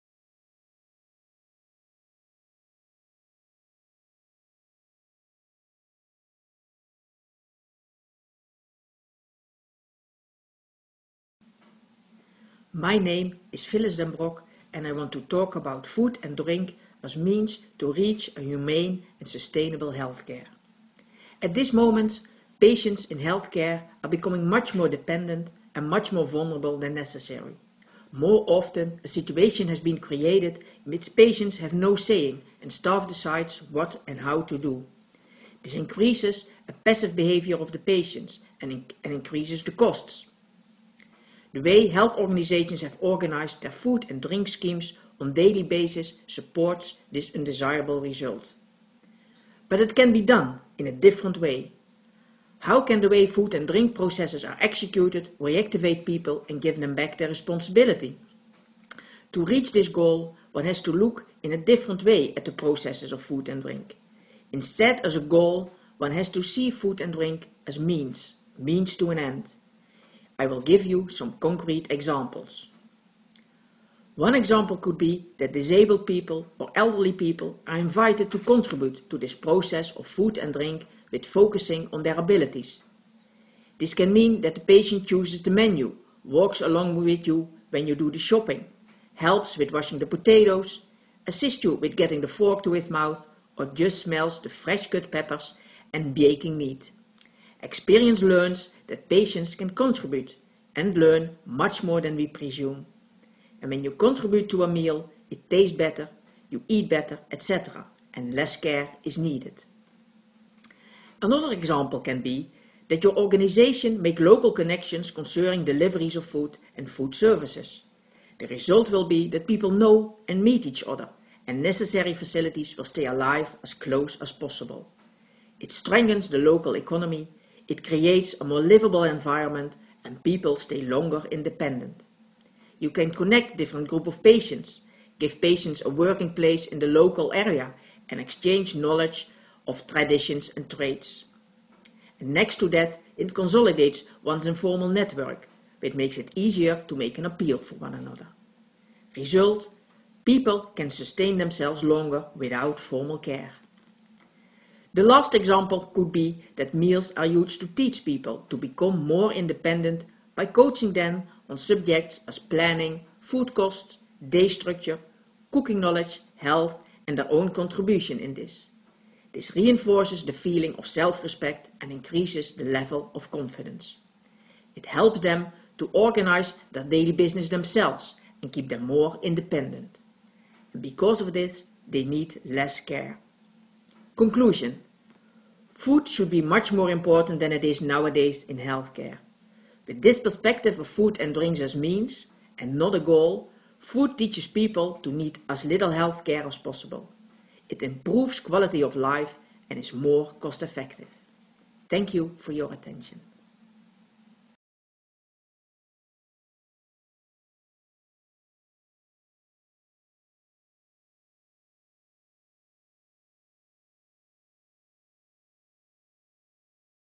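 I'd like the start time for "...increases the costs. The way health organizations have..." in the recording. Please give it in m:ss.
0:39.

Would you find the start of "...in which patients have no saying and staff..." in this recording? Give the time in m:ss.
0:30.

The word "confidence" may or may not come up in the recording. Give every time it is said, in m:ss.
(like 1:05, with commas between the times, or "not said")
2:53.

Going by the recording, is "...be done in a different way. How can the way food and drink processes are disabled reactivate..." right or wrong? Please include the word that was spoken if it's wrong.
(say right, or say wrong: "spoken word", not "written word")
wrong: "executed", not "disabled".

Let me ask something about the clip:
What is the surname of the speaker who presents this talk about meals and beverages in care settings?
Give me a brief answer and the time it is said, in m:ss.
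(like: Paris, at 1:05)
Den, at 0:13.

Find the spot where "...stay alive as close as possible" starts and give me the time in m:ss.
2:02.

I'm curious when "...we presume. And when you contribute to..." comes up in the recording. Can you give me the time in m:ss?
1:42.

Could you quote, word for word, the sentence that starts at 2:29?
Result, people can sustain themselves longer without formal care.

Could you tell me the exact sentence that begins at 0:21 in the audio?
At this moment, patients in healthcare are becoming much more dependent and much more vulnerable than necessary.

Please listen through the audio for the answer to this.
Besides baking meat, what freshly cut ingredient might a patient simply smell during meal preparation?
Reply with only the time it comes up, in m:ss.
1:34.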